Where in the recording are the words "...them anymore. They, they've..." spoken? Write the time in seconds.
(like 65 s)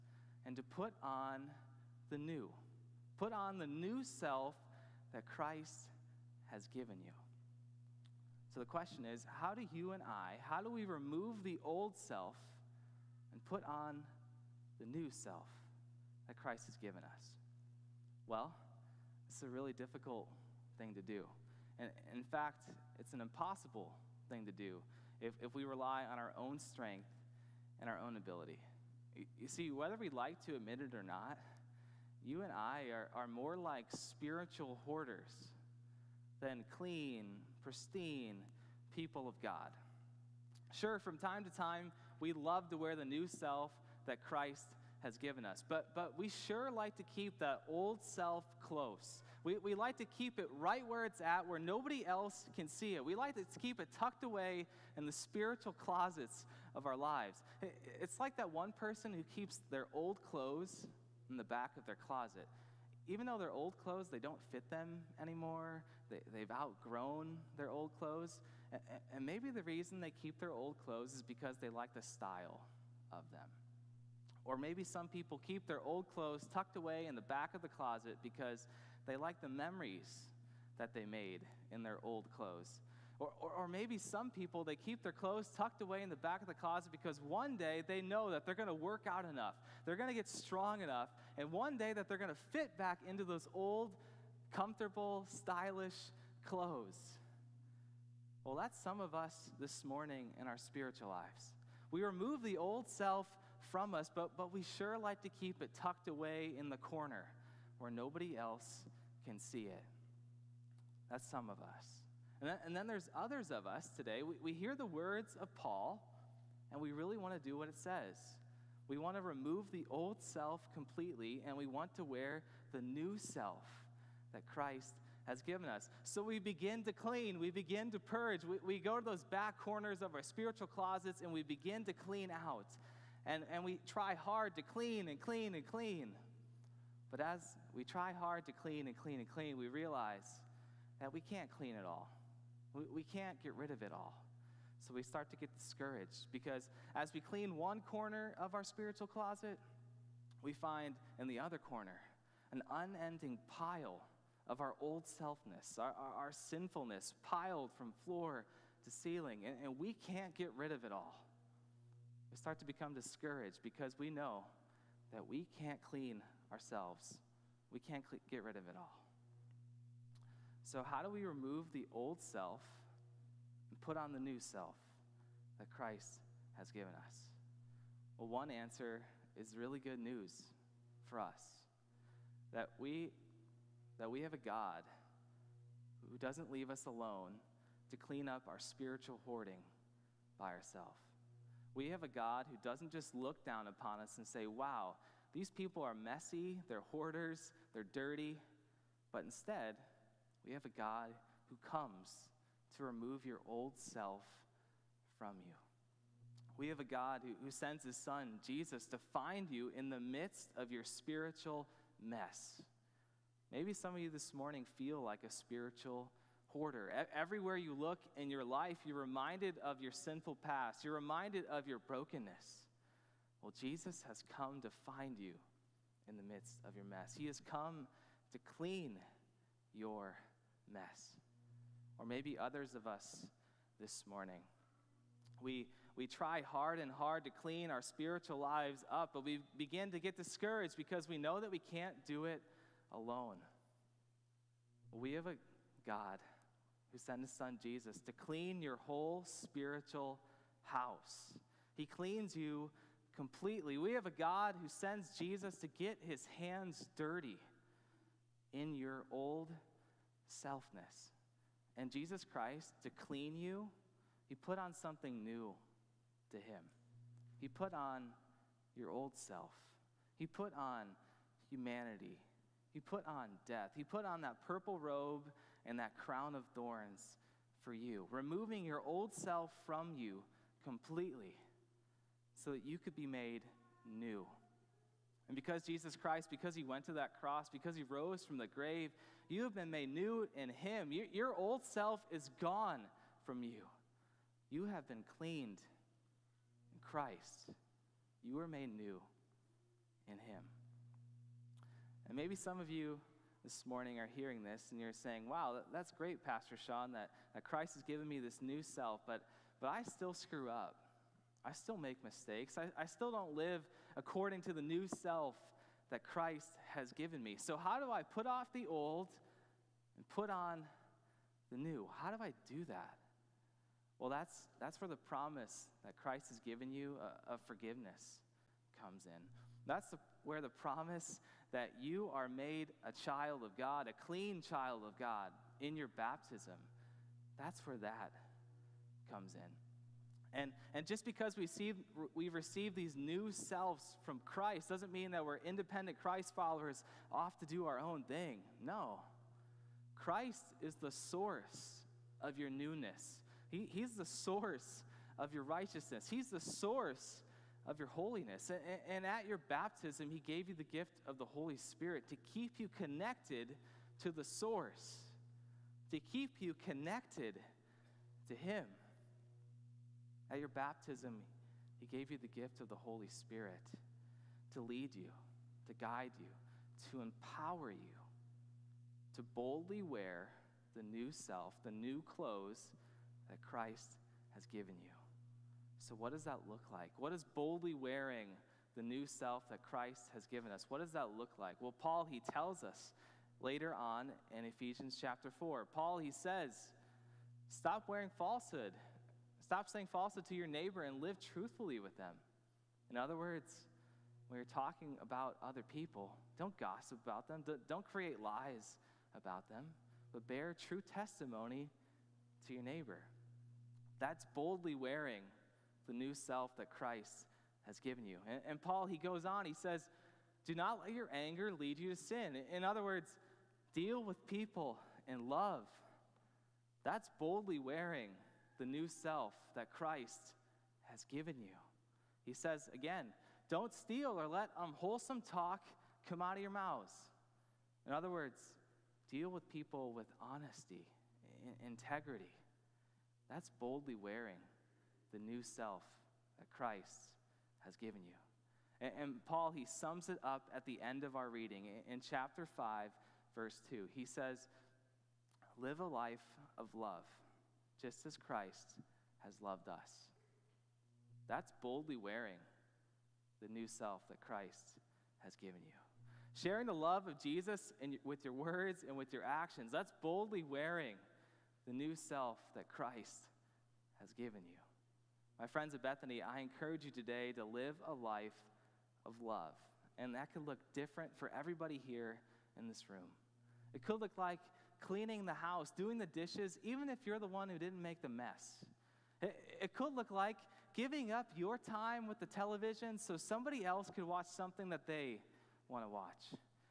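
64 s.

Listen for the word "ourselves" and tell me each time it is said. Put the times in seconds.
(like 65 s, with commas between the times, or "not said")
166 s, 190 s.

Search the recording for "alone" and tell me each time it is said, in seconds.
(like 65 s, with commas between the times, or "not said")
186 s, 242 s.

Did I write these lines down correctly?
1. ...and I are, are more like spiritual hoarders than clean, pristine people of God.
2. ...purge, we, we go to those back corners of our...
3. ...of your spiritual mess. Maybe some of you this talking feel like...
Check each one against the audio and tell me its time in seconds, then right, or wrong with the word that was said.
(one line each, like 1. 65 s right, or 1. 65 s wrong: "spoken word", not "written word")
1. 32 s right
2. 127 s right
3. 210 s wrong: "morning", not "talking".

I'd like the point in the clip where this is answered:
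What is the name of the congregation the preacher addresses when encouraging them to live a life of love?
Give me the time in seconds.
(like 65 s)
475 s.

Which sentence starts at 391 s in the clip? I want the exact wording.
Well, Paul, he tells us later on in Ephesians chapter 4.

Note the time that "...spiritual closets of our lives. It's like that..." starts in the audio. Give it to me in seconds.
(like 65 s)
55 s.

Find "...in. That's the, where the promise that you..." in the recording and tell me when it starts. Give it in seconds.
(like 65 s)
329 s.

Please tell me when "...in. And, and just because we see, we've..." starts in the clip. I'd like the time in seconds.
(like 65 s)
339 s.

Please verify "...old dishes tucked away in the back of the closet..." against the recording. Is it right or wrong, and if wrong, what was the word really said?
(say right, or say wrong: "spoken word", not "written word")
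wrong: "clothes", not "dishes".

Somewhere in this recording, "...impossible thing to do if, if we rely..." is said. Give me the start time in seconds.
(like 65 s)
23 s.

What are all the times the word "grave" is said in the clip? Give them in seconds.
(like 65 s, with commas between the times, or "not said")
288 s.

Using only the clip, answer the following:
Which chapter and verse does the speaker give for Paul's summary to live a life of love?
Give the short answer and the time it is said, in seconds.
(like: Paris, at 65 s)
Chapter 5, verse 2, at 452 s.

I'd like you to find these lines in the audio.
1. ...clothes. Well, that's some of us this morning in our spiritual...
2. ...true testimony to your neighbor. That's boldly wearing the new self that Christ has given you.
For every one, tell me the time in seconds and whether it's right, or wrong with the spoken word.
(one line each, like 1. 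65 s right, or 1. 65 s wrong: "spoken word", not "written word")
1. 96 s right
2. 410 s right.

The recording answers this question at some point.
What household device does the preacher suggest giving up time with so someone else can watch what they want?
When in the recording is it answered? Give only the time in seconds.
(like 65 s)
492 s.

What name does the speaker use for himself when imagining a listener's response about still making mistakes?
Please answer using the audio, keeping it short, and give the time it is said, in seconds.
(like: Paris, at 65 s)
Pastor Sean, at 306 s.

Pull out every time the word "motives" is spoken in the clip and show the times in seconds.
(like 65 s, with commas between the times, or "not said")
not said.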